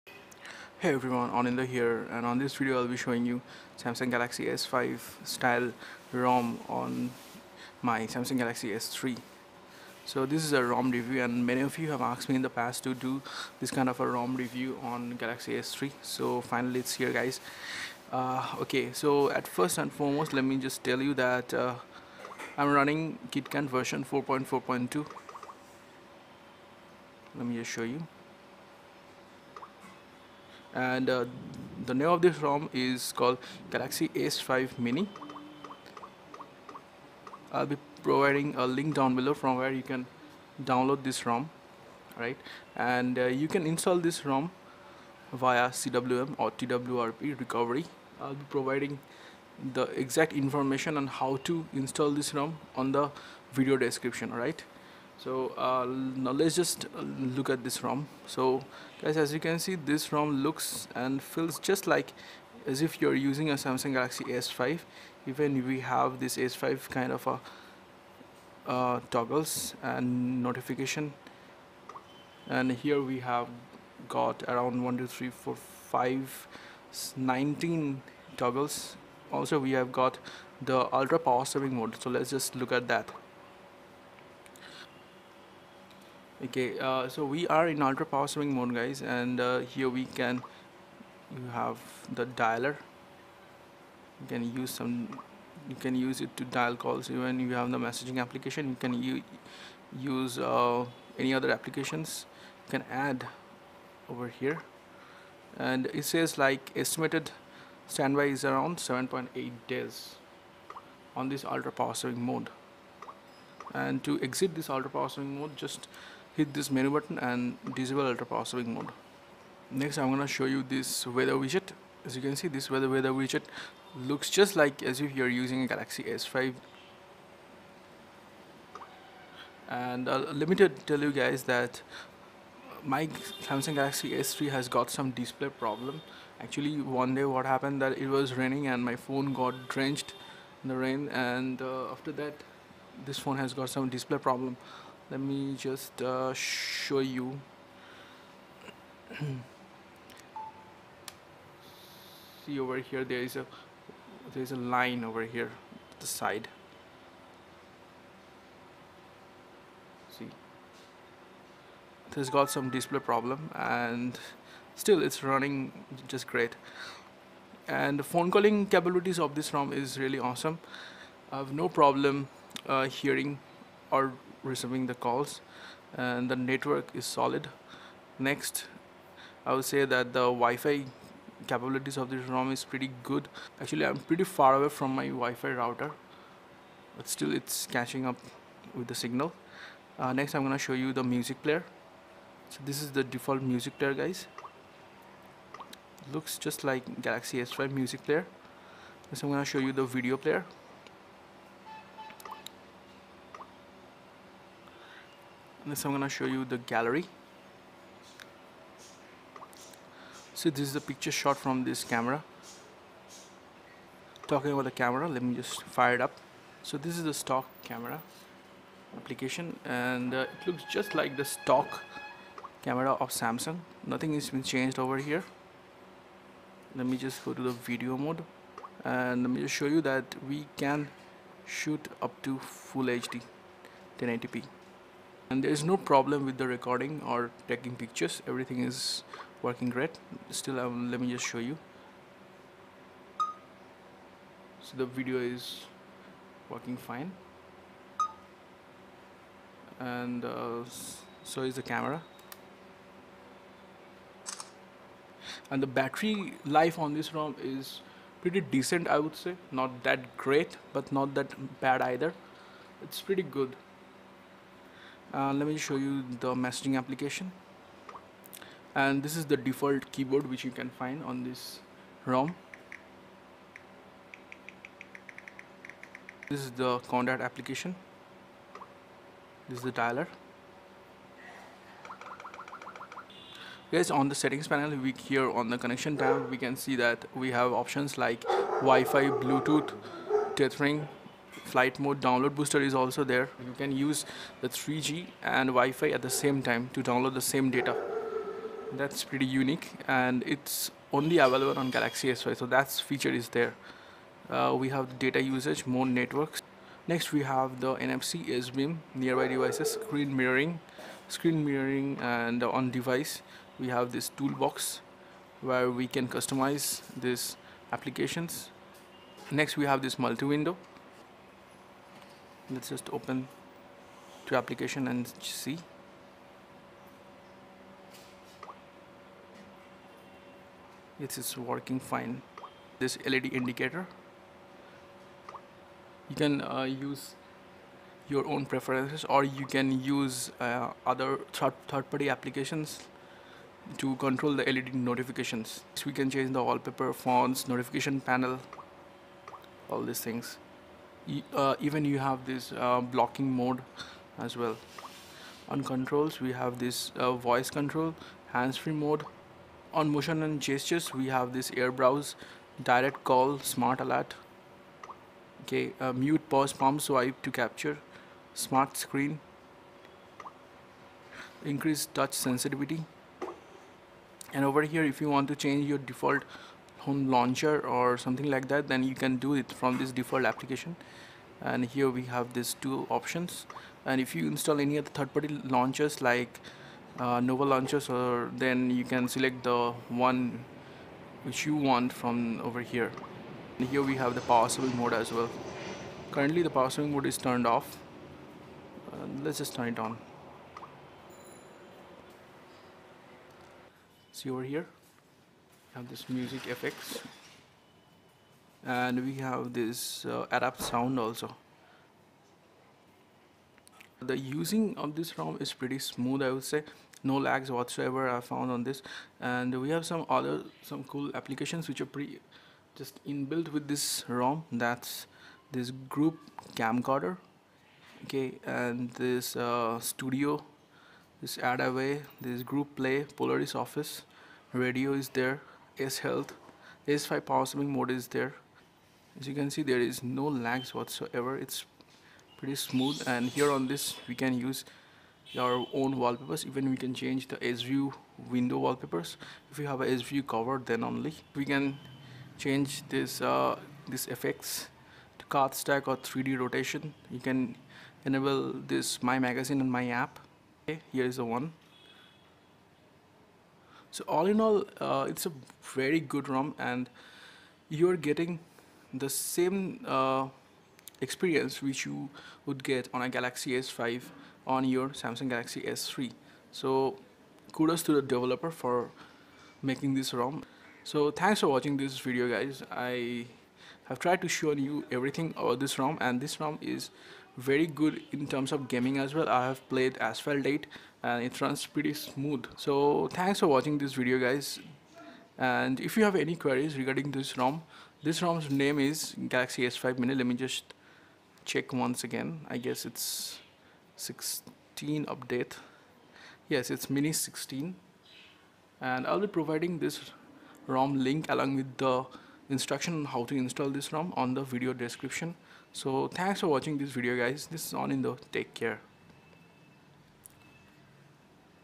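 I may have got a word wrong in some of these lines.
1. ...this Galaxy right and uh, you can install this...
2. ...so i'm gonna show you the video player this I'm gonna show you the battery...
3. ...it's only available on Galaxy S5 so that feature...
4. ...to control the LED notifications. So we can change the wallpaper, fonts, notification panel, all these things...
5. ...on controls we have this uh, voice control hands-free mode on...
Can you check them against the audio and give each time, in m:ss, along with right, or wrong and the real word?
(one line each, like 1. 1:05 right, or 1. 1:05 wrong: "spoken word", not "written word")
1. 0:41 wrong: "ROM", not "Galaxy"
2. 3:19 wrong: "gallery", not "battery"
3. 5:00 right
4. 5:43 right
5. 5:55 right.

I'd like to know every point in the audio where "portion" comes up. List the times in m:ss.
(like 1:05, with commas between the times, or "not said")
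not said.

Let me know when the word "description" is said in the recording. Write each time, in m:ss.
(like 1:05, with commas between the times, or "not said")
0:53, 8:34.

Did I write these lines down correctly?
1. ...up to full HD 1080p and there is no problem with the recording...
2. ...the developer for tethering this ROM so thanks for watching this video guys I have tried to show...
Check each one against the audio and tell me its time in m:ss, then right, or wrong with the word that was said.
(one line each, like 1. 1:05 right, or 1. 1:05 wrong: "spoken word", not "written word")
1. 3:52 right
2. 7:57 wrong: "making", not "tethering".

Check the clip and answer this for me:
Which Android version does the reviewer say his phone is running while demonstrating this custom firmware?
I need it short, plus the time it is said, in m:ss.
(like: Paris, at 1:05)
4.4.2, at 0:24.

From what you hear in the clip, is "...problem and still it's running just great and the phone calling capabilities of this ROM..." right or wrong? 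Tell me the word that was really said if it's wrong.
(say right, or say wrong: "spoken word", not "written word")
right.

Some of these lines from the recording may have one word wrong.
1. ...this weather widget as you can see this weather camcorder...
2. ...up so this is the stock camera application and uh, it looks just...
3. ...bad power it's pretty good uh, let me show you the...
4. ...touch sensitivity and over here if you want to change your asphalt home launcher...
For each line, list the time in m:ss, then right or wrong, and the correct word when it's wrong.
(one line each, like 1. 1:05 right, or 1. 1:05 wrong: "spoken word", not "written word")
1. 2:00 wrong: "weather", not "camcorder"
2. 3:36 right
3. 4:21 wrong: "either", not "power"
4. 6:11 wrong: "default", not "asphalt".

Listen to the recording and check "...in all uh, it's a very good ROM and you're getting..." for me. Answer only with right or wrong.
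right.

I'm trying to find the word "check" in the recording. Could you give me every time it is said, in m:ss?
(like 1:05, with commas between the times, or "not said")
8:21.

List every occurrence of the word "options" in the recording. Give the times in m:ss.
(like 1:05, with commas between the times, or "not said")
4:47, 6:22.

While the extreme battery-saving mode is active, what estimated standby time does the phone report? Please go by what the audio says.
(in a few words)
7.8 days.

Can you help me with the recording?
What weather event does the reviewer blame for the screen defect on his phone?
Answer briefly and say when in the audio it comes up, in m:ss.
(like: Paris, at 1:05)
Rain, at 2:18.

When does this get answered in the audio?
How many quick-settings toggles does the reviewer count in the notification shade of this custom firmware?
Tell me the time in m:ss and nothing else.
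1:17.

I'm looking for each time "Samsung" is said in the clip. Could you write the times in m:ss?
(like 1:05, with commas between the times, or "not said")
0:03, 0:08, 1:03, 2:13, 3:43, 7:54.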